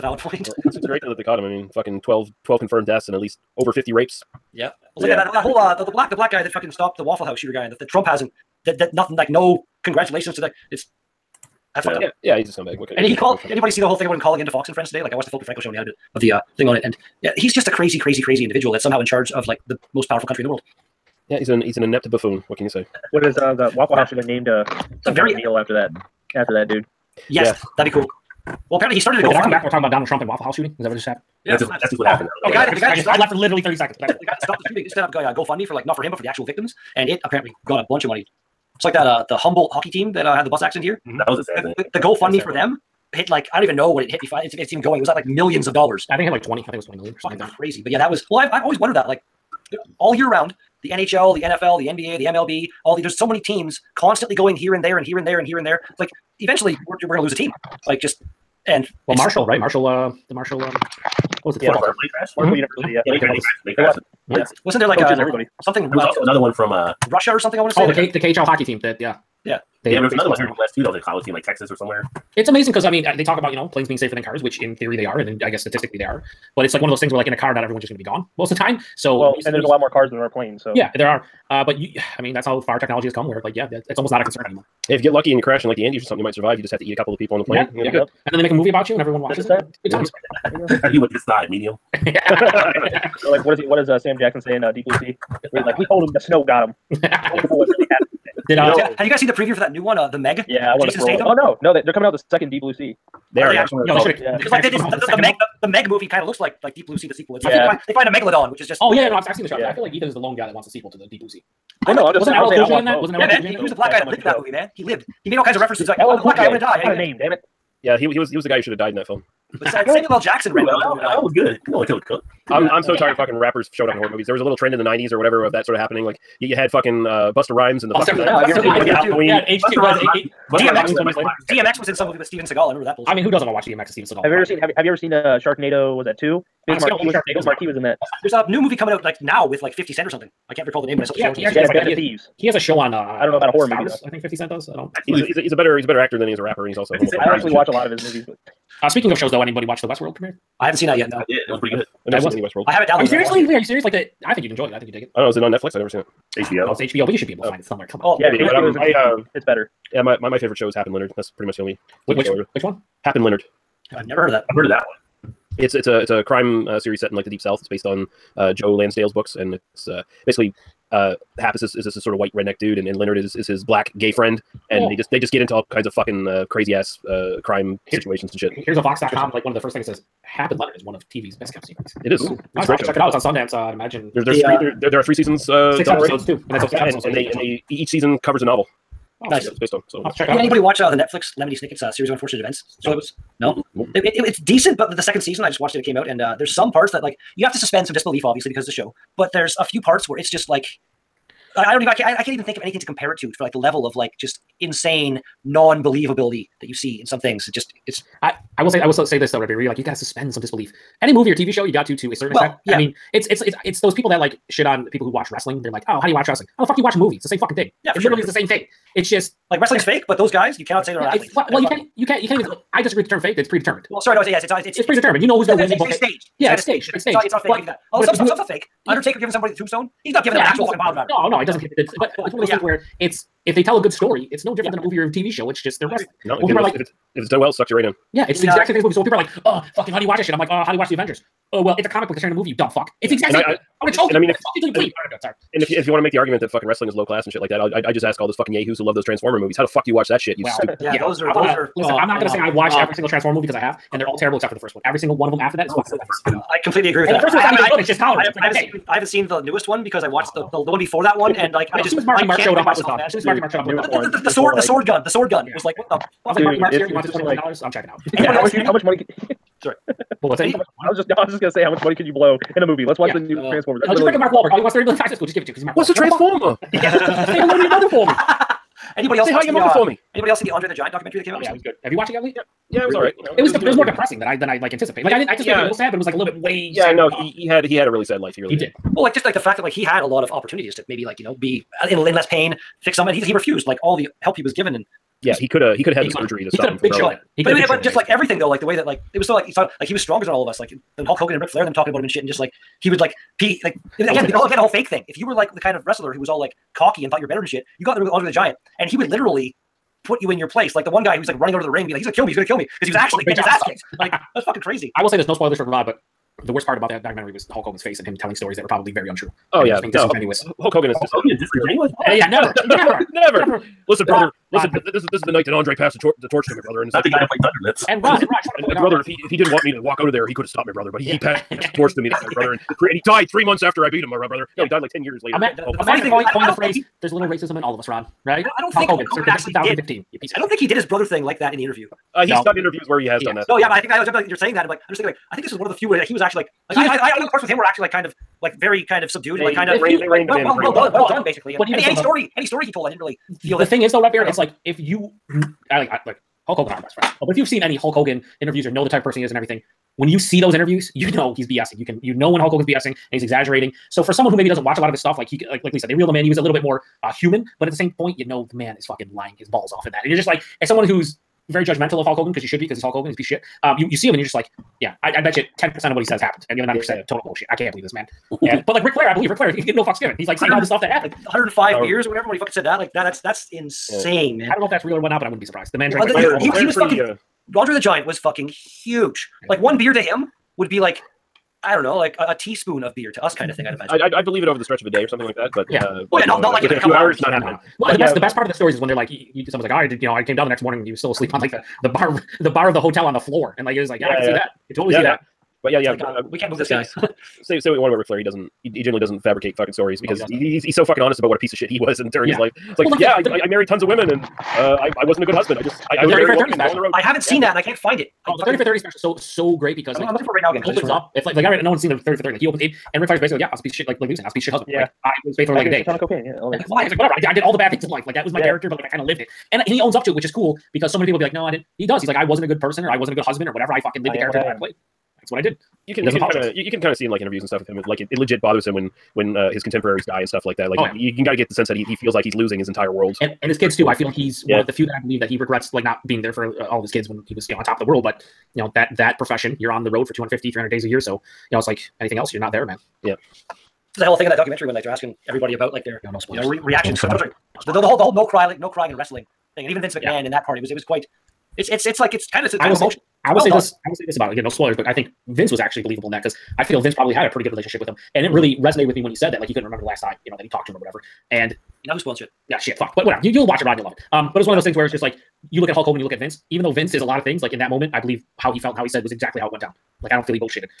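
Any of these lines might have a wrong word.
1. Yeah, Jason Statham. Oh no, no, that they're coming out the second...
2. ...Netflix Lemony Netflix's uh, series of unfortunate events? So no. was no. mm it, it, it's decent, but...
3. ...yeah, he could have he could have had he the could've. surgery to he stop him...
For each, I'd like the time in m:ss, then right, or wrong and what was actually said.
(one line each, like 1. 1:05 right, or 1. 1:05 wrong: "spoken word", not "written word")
1. 1:40 right
2. 3:10 wrong: "Snicket", not "Netflix"
3. 4:55 right.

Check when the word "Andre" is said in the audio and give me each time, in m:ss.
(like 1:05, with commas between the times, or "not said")
4:40, 5:08, 5:25, 6:27.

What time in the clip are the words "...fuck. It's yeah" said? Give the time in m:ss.
4:02.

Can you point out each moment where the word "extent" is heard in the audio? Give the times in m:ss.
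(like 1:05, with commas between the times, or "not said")
3:32.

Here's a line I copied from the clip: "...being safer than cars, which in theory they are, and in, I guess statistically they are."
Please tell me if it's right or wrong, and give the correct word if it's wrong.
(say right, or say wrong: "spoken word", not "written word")
right.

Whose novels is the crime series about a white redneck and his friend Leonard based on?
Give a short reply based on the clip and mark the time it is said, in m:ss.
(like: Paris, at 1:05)
Joe Lansdale, at 2:48.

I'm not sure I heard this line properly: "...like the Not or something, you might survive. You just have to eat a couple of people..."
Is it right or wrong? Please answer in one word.
wrong.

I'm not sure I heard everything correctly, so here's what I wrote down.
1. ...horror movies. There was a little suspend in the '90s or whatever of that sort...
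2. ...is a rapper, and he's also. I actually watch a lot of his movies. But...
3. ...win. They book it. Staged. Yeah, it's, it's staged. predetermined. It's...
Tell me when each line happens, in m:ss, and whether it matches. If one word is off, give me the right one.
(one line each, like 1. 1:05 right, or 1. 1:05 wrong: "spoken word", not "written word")
1. 2:03 wrong: "trend", not "suspend"
2. 2:26 right
3. 3:45 wrong: "staged", not "predetermined".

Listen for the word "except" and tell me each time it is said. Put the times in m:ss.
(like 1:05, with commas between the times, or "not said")
4:14.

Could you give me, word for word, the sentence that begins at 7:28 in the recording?
But you know that that profession, you're on the road for 250, 300 days a year.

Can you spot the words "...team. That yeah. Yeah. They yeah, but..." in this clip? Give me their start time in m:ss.
1:08.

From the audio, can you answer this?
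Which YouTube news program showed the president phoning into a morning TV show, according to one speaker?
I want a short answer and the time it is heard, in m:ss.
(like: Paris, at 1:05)
The Philip DeFranco show, at 0:15.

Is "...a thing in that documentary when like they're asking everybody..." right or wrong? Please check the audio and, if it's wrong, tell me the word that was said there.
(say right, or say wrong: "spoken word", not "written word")
right.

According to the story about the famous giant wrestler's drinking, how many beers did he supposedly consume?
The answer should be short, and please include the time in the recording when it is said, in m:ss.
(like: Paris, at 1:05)
105, at 6:21.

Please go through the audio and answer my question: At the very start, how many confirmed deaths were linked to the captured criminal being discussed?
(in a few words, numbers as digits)
12.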